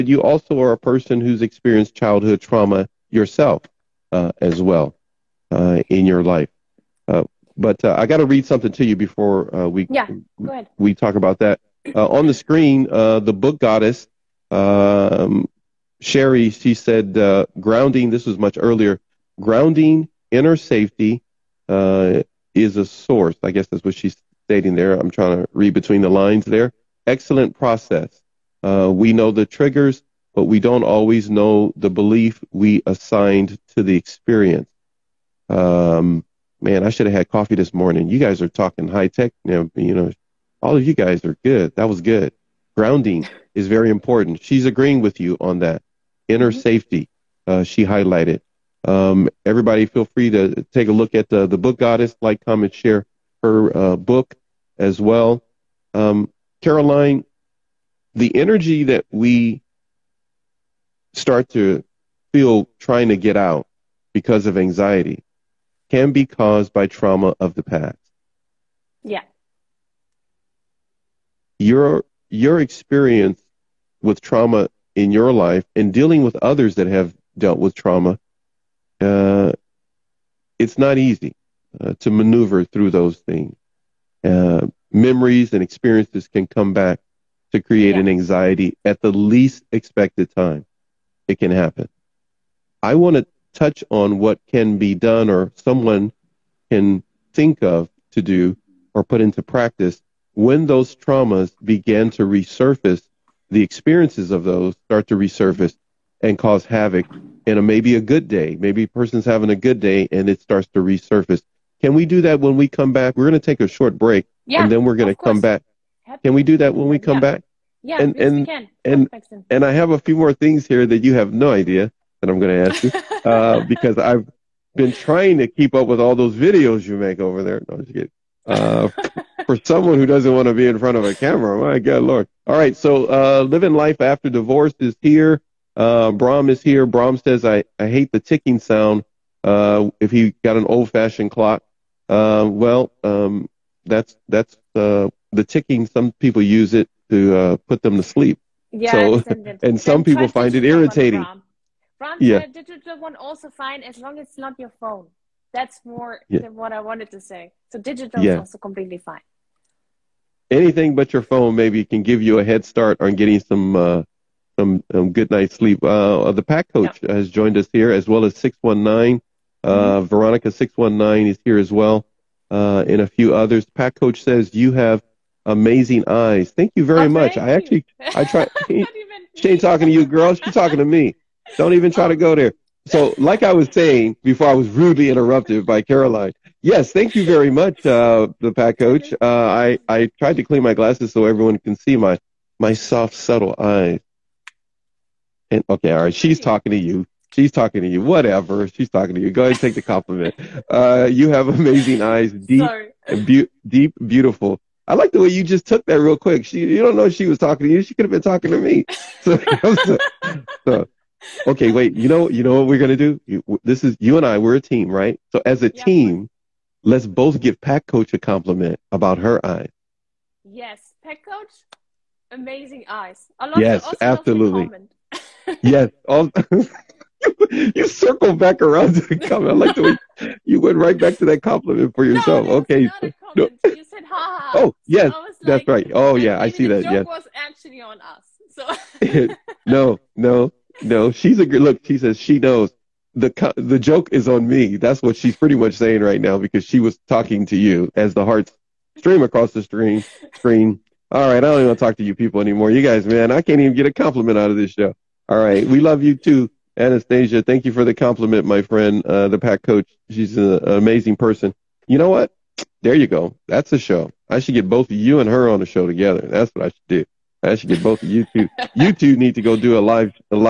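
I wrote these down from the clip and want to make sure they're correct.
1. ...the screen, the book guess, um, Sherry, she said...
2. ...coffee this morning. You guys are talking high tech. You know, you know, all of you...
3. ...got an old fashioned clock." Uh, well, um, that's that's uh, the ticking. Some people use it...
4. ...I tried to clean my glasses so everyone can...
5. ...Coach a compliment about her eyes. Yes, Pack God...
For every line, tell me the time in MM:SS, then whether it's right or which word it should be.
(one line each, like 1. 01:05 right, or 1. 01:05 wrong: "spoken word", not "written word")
1. 00:12 wrong: "goddess", not "guess"
2. 00:37 right
3. 02:20 right
4. 03:09 right
5. 03:37 wrong: "Coach", not "God".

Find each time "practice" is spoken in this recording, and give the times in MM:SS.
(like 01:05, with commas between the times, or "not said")
01:39.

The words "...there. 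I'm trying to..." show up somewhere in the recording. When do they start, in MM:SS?
00:24.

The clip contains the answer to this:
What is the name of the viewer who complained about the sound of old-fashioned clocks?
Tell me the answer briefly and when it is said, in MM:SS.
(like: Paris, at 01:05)
Brahm, at 02:16.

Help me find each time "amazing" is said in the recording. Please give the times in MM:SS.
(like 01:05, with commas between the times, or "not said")
02:55, 03:21, 03:42, 04:20.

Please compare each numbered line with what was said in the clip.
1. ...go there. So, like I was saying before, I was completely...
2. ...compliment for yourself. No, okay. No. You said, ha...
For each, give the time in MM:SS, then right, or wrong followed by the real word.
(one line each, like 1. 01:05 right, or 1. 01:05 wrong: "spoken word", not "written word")
1. 03:02 wrong: "rudely", not "completely"
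2. 03:51 right.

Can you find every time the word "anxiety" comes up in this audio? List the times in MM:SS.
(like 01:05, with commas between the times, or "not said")
01:04, 01:28.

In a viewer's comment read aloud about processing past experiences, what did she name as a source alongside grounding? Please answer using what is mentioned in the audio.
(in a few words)
Inner safety.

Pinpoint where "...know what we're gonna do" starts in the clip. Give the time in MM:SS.
03:32.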